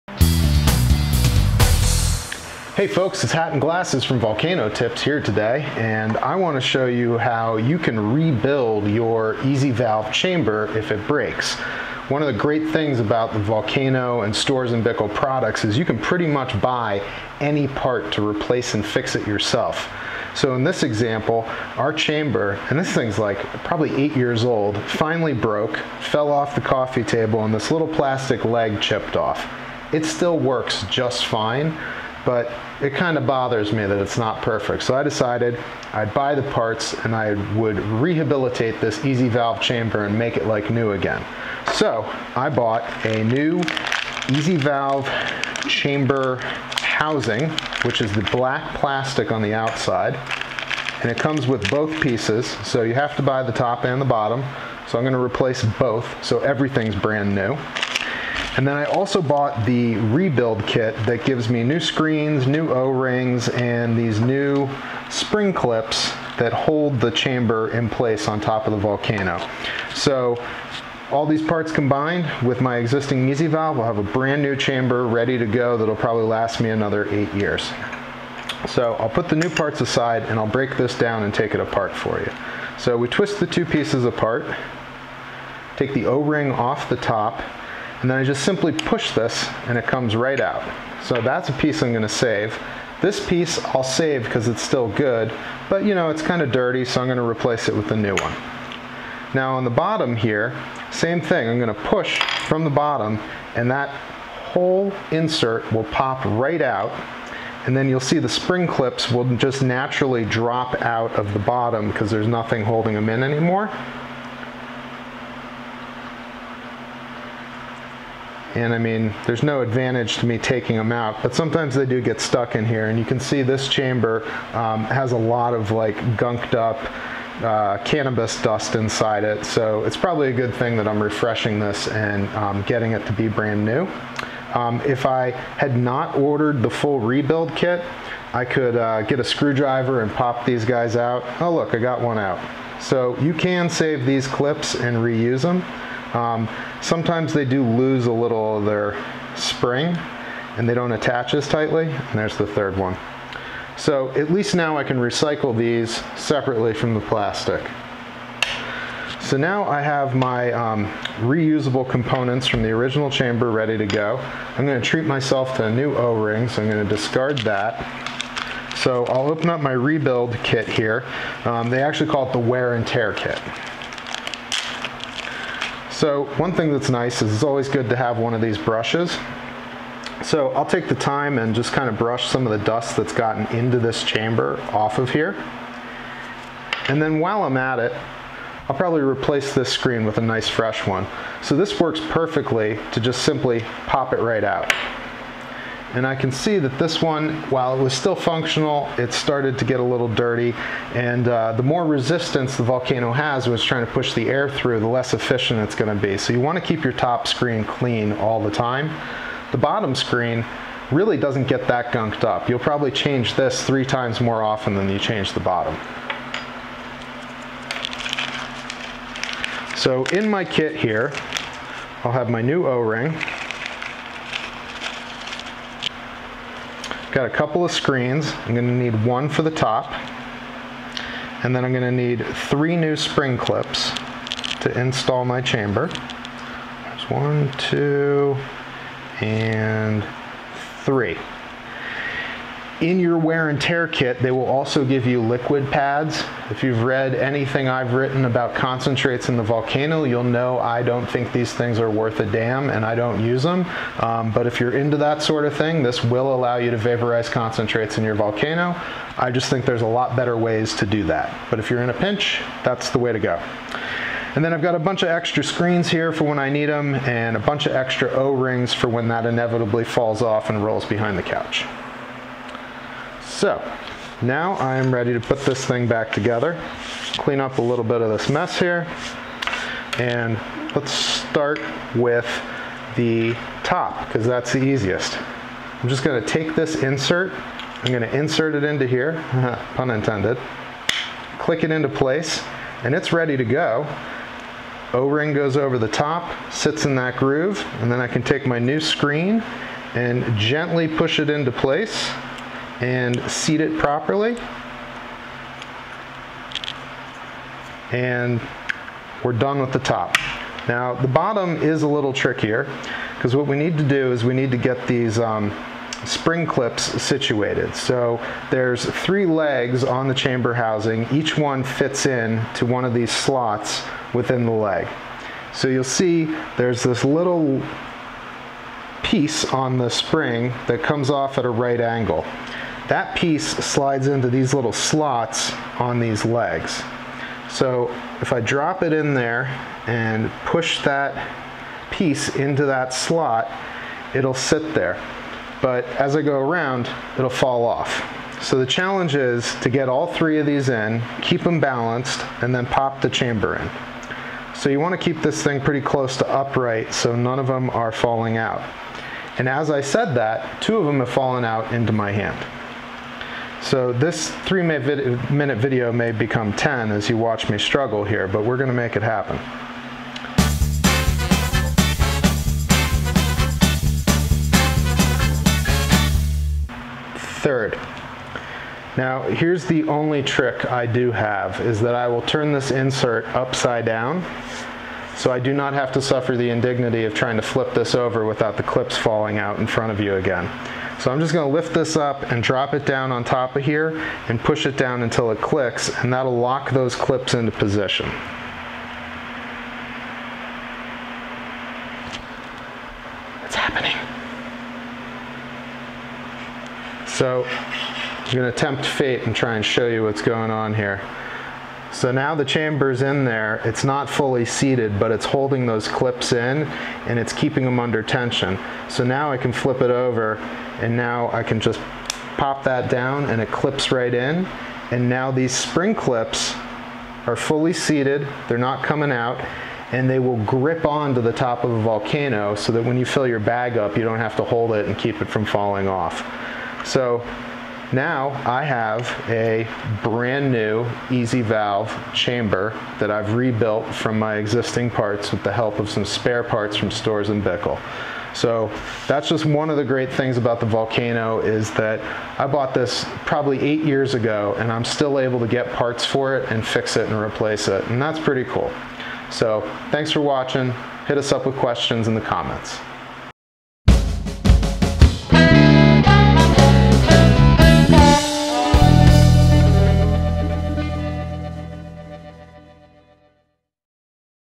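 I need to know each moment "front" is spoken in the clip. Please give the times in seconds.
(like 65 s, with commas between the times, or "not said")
389 s.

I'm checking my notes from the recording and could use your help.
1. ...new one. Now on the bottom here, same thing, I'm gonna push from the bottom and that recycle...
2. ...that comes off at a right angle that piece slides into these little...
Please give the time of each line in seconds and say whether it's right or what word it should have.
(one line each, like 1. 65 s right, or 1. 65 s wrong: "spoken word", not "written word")
1. 97 s wrong: "whole", not "recycle"
2. 330 s right.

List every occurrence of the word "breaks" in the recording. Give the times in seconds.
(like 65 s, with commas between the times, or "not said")
11 s, 80 s.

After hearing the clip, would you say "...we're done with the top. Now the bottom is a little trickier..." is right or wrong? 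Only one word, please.
right.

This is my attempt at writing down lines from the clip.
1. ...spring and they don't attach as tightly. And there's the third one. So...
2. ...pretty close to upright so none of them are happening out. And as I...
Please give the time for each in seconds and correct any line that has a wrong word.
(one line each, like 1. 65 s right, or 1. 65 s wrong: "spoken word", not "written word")
1. 149 s right
2. 355 s wrong: "falling", not "happening".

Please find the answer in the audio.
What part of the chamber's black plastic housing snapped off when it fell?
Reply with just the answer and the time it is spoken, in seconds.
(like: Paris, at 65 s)
plastic leg, at 27 s.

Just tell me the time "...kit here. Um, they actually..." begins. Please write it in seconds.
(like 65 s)
170 s.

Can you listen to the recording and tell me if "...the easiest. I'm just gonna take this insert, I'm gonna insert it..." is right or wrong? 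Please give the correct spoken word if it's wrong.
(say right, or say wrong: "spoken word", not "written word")
right.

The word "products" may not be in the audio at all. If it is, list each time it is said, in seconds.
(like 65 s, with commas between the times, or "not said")
15 s.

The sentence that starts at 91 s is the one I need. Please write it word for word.
So that's a piece I'm gonna save.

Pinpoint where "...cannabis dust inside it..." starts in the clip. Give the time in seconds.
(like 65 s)
127 s.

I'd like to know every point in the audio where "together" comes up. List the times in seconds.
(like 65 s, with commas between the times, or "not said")
276 s.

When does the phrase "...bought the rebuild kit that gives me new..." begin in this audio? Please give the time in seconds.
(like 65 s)
59 s.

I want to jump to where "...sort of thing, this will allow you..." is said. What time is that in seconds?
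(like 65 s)
255 s.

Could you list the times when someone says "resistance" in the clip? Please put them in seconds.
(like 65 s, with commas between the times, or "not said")
201 s.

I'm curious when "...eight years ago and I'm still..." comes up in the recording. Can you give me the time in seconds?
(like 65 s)
453 s.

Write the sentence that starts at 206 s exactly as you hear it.
So you wanna keep your top screen clean all the time.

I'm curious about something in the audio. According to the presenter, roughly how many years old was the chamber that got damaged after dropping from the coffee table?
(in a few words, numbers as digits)
8.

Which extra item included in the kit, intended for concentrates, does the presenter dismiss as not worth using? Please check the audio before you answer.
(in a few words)
liquid pads.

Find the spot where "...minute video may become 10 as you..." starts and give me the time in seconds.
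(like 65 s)
364 s.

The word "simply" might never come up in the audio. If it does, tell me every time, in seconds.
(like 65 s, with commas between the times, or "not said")
88 s, 193 s.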